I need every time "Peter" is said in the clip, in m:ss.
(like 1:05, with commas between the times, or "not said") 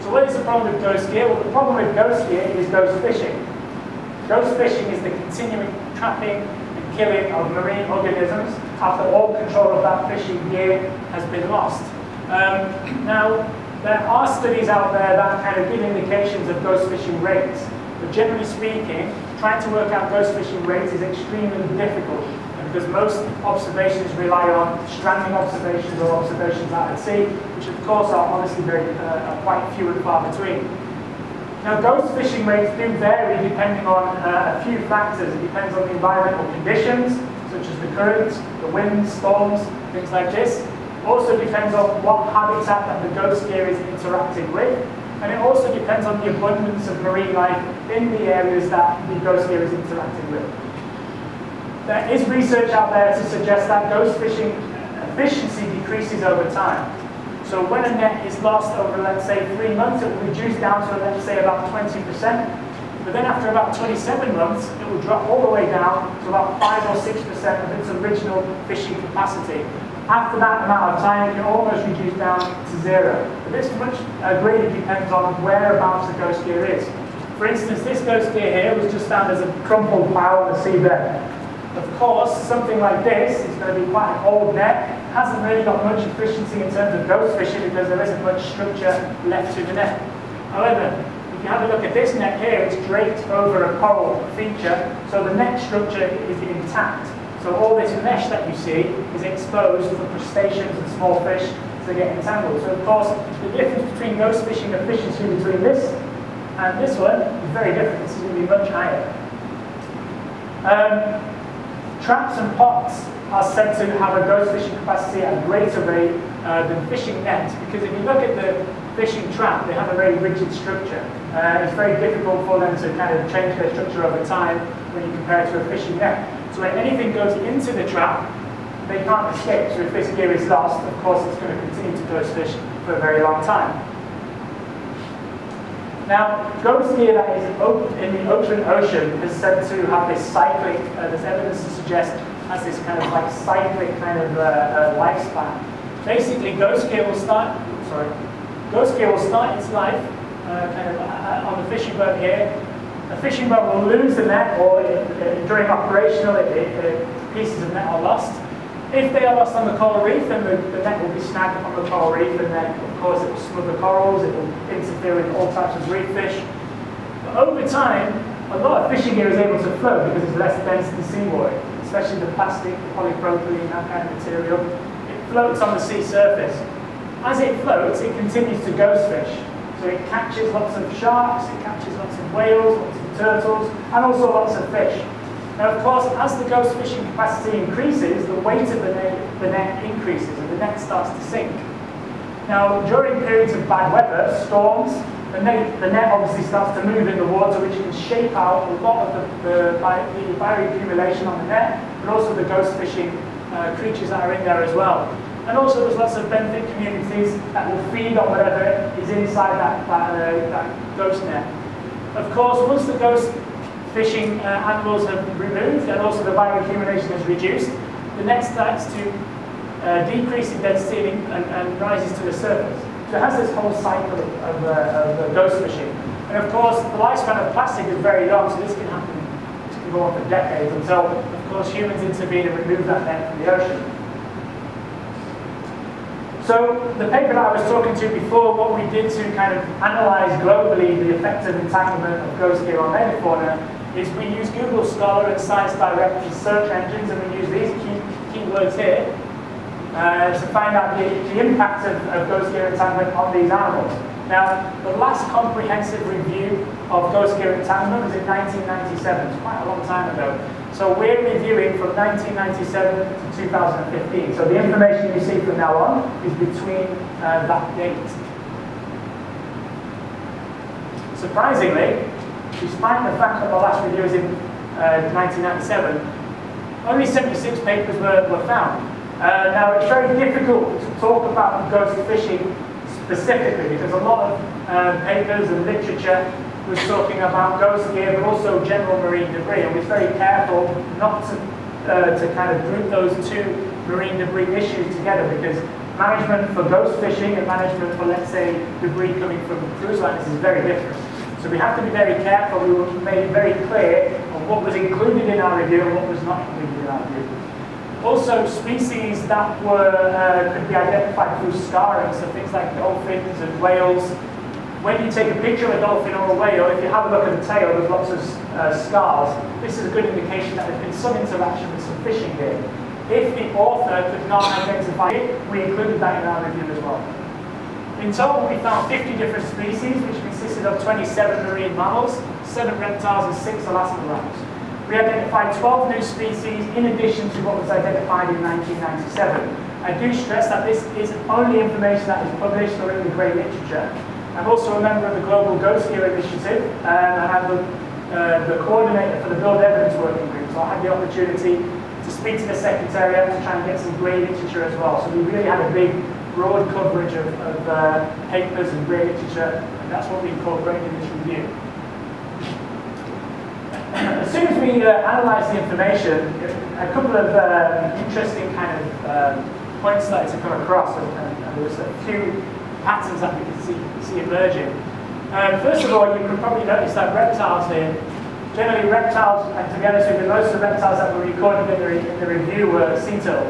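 not said.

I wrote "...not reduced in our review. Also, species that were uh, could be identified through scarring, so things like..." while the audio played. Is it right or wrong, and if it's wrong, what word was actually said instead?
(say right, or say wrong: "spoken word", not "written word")
wrong: "included", not "reduced".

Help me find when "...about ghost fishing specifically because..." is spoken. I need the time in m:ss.
4:41.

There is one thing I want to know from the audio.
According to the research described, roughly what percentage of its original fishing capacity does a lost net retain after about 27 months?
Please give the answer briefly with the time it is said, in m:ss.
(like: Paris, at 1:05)
5 or 6%, at 1:06.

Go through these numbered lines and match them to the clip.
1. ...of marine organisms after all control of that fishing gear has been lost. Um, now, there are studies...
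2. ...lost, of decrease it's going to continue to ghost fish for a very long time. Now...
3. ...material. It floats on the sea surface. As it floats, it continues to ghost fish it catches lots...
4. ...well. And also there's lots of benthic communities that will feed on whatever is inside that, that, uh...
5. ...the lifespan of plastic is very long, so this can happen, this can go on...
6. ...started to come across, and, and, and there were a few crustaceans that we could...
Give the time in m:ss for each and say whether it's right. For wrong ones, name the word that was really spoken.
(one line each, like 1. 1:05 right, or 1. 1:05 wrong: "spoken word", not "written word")
1. 0:07 right
2. 2:10 wrong: "course", not "decrease"
3. 2:54 right
4. 3:24 right
5. 3:46 right
6. 6:10 wrong: "patterns", not "crustaceans".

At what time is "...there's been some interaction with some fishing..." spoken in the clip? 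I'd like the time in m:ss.
5:20.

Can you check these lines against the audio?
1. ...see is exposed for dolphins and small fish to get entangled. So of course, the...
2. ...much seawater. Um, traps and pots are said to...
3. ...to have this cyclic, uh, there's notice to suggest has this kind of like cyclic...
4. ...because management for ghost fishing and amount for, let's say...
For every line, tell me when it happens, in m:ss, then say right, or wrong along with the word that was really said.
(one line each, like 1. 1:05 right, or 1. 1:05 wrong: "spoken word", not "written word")
1. 1:38 wrong: "crustaceans", not "dolphins"
2. 1:48 wrong: "higher", not "seawater"
3. 2:19 wrong: "evidence", not "notice"
4. 4:55 wrong: "management", not "amount".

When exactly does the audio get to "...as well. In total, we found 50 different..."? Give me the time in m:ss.
5:26.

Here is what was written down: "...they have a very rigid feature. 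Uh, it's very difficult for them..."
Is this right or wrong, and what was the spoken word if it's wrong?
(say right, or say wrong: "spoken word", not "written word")
wrong: "structure", not "feature".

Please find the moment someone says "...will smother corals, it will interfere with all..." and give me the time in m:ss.
2:43.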